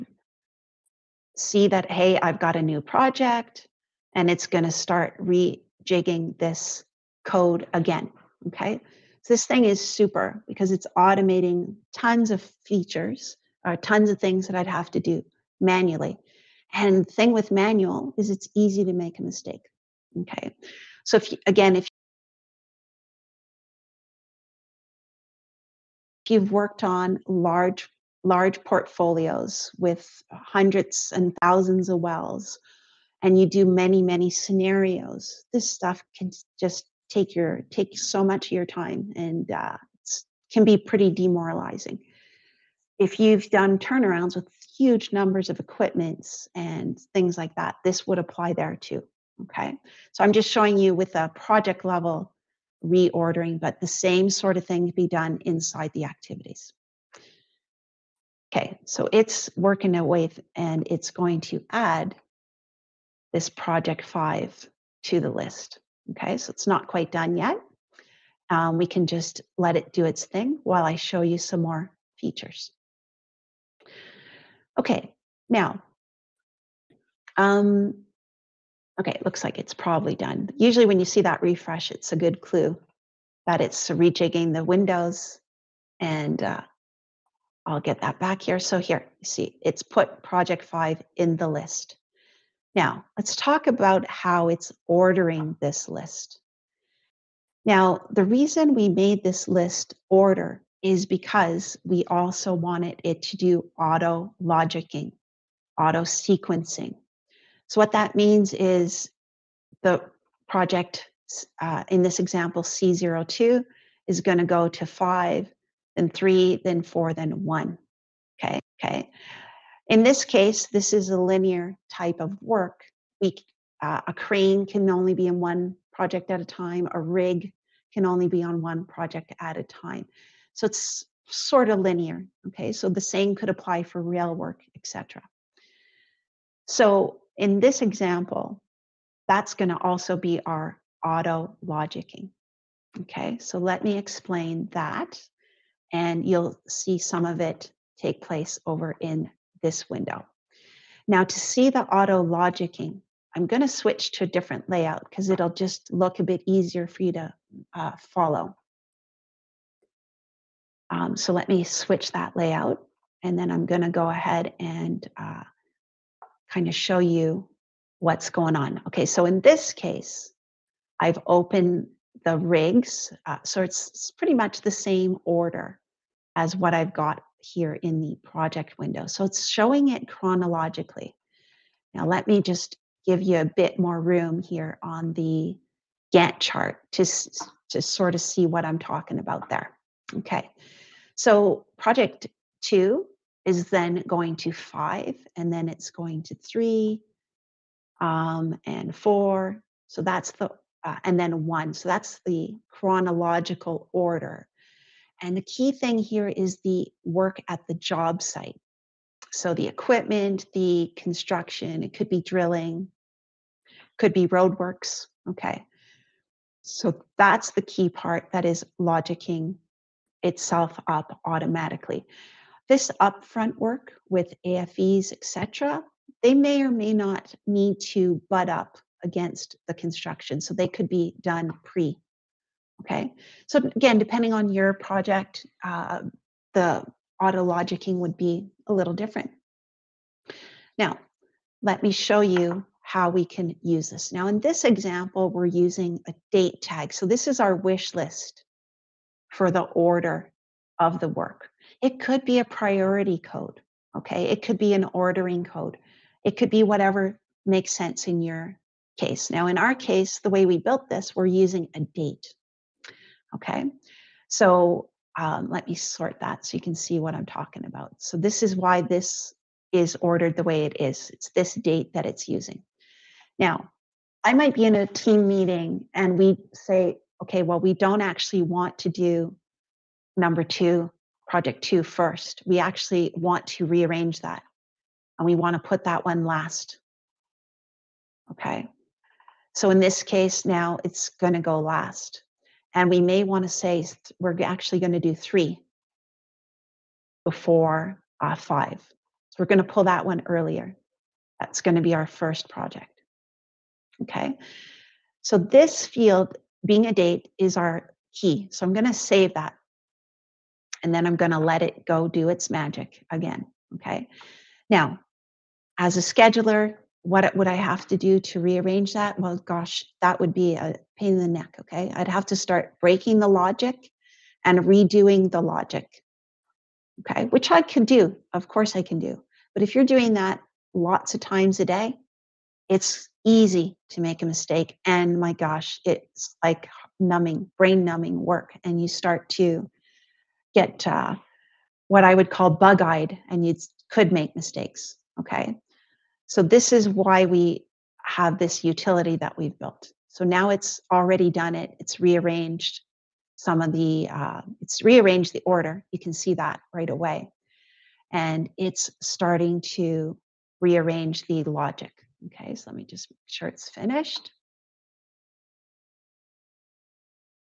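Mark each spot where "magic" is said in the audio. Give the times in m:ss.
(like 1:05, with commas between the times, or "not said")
5:12.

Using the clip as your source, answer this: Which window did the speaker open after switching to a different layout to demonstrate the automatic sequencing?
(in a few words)
The rigs.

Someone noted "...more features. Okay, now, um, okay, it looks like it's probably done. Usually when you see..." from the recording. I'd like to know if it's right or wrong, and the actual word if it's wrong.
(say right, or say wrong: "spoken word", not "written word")
right.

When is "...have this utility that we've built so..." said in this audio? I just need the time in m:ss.
5:48.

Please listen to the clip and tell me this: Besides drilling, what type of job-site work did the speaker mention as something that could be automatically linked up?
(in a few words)
Roadworks.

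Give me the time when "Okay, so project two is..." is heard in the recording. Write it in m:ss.
3:10.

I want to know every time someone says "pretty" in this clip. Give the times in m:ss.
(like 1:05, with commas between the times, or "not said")
0:40, 2:54.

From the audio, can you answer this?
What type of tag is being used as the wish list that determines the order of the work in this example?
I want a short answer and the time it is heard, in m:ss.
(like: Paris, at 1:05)
A date tag, at 4:06.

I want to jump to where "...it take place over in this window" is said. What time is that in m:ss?
2:27.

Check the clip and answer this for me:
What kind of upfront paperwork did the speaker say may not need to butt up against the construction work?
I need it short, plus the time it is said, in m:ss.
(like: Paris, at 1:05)
AFEs, at 3:44.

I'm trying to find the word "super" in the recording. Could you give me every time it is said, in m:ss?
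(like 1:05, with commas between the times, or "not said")
0:09.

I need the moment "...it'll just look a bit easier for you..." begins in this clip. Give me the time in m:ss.
2:35.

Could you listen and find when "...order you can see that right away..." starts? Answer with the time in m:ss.
5:55.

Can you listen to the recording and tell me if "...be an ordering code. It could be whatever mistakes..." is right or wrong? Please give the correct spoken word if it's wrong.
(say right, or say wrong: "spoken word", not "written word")
wrong: "makes", not "mistakes".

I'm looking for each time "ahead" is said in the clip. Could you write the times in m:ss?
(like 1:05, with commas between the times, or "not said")
2:44.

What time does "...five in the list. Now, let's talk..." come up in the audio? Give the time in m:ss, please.
1:30.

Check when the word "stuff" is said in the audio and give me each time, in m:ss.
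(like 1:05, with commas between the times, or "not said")
0:35.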